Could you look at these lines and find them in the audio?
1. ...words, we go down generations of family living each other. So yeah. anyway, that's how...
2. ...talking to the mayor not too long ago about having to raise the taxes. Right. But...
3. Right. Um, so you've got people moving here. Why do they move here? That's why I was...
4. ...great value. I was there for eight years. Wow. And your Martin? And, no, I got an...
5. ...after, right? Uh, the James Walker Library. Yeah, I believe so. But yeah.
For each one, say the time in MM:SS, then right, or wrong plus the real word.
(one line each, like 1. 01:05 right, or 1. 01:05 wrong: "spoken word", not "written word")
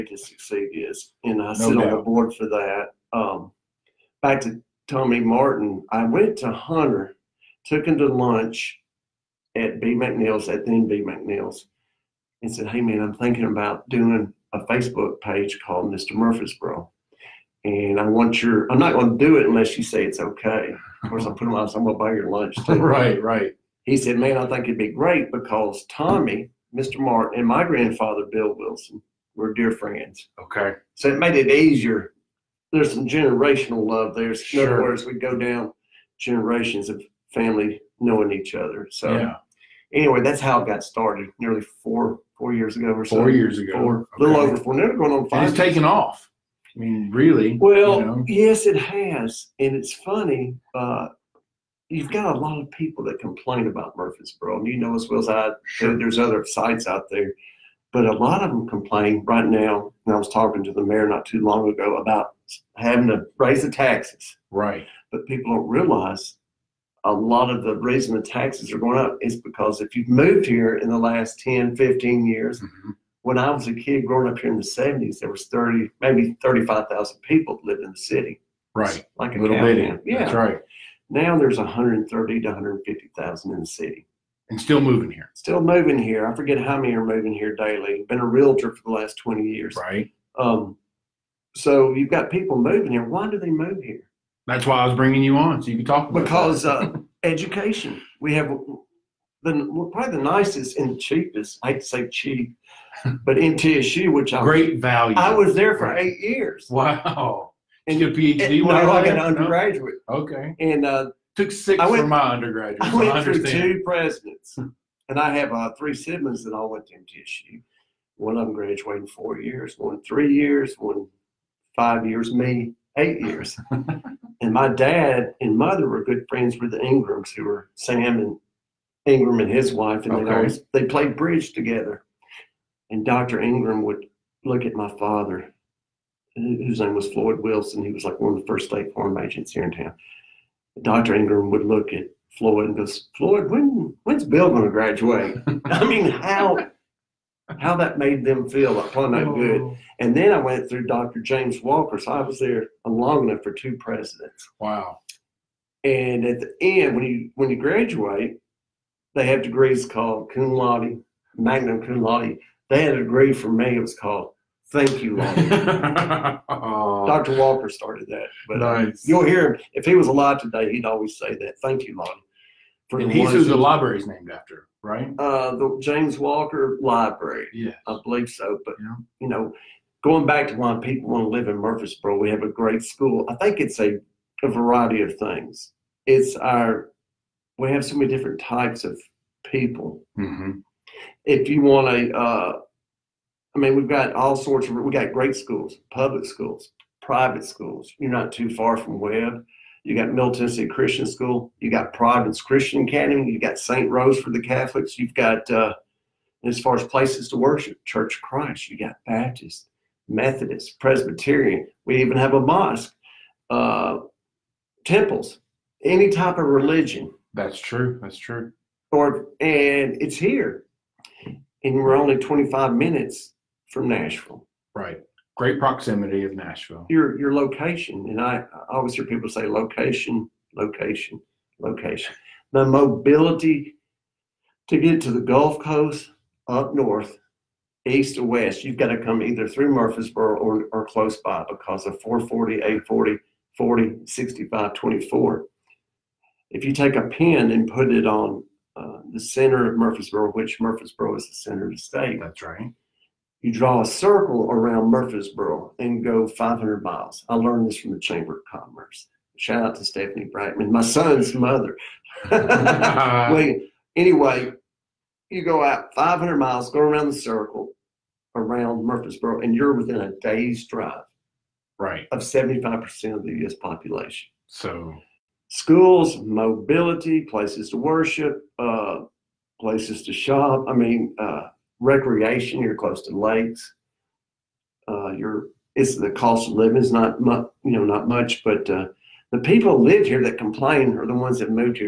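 1. 00:34 wrong: "knowing", not "living"
2. 01:00 right
3. 01:29 right
4. 01:44 wrong: "PhD", not "Martin"
5. 02:54 right.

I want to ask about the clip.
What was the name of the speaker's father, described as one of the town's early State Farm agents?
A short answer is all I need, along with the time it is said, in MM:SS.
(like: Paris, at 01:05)
Floyd Wilson, at 02:17.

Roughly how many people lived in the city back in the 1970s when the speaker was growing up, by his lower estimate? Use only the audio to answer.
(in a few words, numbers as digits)
30,000.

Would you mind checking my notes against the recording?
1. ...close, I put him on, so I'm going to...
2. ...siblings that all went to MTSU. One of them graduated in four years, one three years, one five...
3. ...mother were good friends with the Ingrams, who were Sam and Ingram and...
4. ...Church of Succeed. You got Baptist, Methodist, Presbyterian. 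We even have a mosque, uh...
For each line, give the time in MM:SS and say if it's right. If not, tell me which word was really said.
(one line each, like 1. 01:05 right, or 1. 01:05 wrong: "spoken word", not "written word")
1. 00:21 wrong: "course", not "close"
2. 01:55 right
3. 02:05 right
4. 03:27 wrong: "Christ", not "Succeed".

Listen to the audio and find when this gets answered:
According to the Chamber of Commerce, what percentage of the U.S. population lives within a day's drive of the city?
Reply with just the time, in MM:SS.
04:32.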